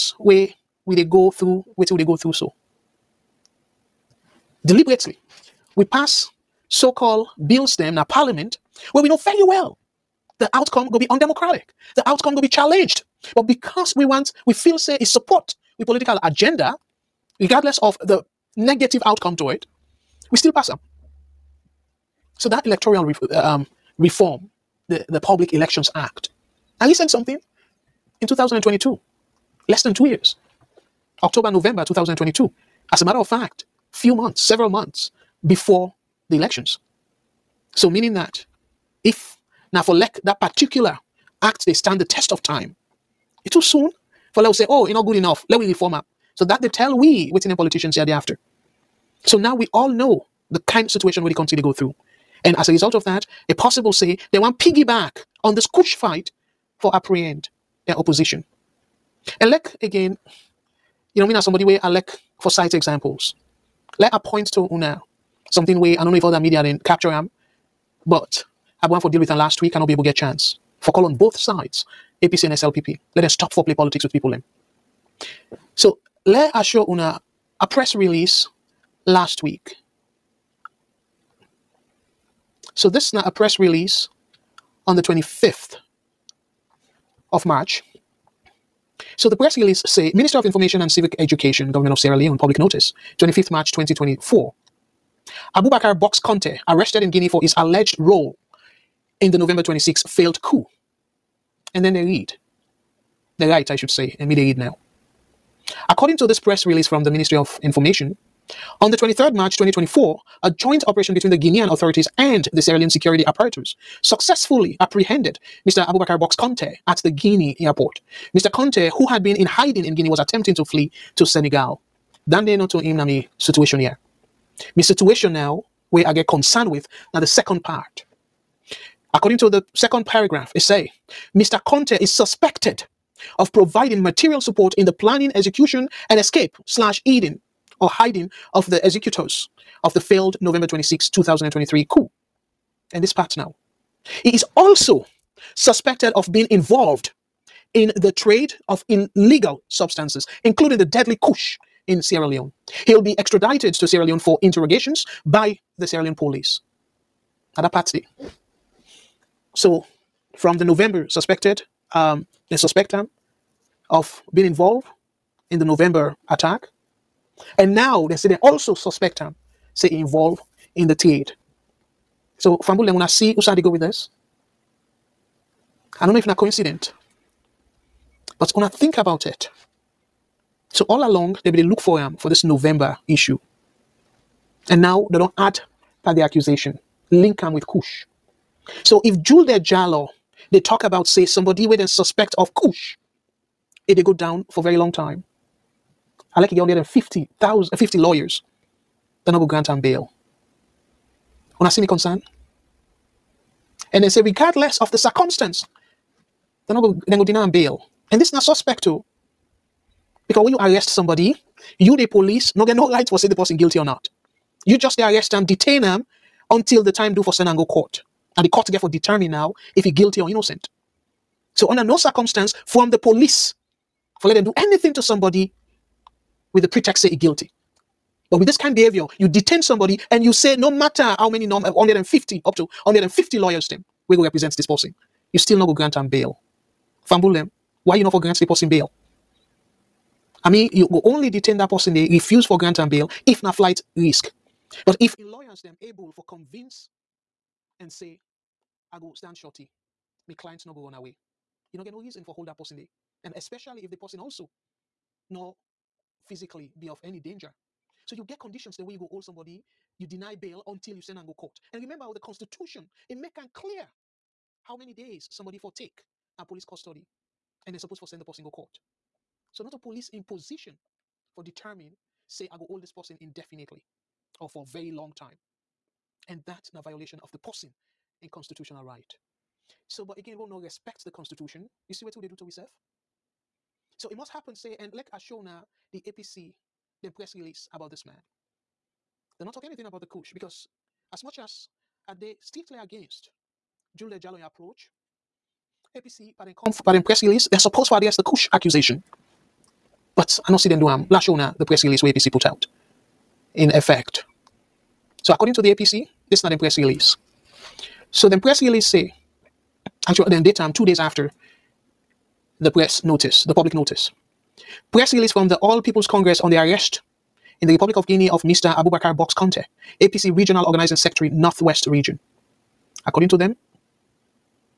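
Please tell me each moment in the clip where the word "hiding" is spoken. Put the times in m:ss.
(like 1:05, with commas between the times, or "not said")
1:59, 2:17.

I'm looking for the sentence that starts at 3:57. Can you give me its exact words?
why you no for grant the person bail?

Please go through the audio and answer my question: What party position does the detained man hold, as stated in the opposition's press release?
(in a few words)
Regional Organizing Secretary.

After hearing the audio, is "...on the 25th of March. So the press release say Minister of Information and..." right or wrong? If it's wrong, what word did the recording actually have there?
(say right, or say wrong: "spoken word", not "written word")
right.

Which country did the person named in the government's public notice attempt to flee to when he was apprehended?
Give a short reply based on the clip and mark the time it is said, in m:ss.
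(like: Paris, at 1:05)
Senegal, at 2:01.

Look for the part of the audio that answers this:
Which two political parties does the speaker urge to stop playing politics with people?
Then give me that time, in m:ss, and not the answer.
1:12.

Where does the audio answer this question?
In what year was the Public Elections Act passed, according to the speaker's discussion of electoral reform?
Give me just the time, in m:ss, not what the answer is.
0:26.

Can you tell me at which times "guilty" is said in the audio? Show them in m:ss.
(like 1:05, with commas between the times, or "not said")
3:33, 3:39, 3:47.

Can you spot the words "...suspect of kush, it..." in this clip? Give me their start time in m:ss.
3:11.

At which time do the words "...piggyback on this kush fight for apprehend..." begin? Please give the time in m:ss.
0:54.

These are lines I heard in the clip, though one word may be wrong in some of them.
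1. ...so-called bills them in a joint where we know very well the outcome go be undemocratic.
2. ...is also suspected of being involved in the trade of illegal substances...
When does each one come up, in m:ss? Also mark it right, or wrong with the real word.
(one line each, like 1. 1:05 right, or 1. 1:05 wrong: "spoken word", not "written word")
1. 0:06 wrong: "parliament", not "joint"
2. 2:24 right.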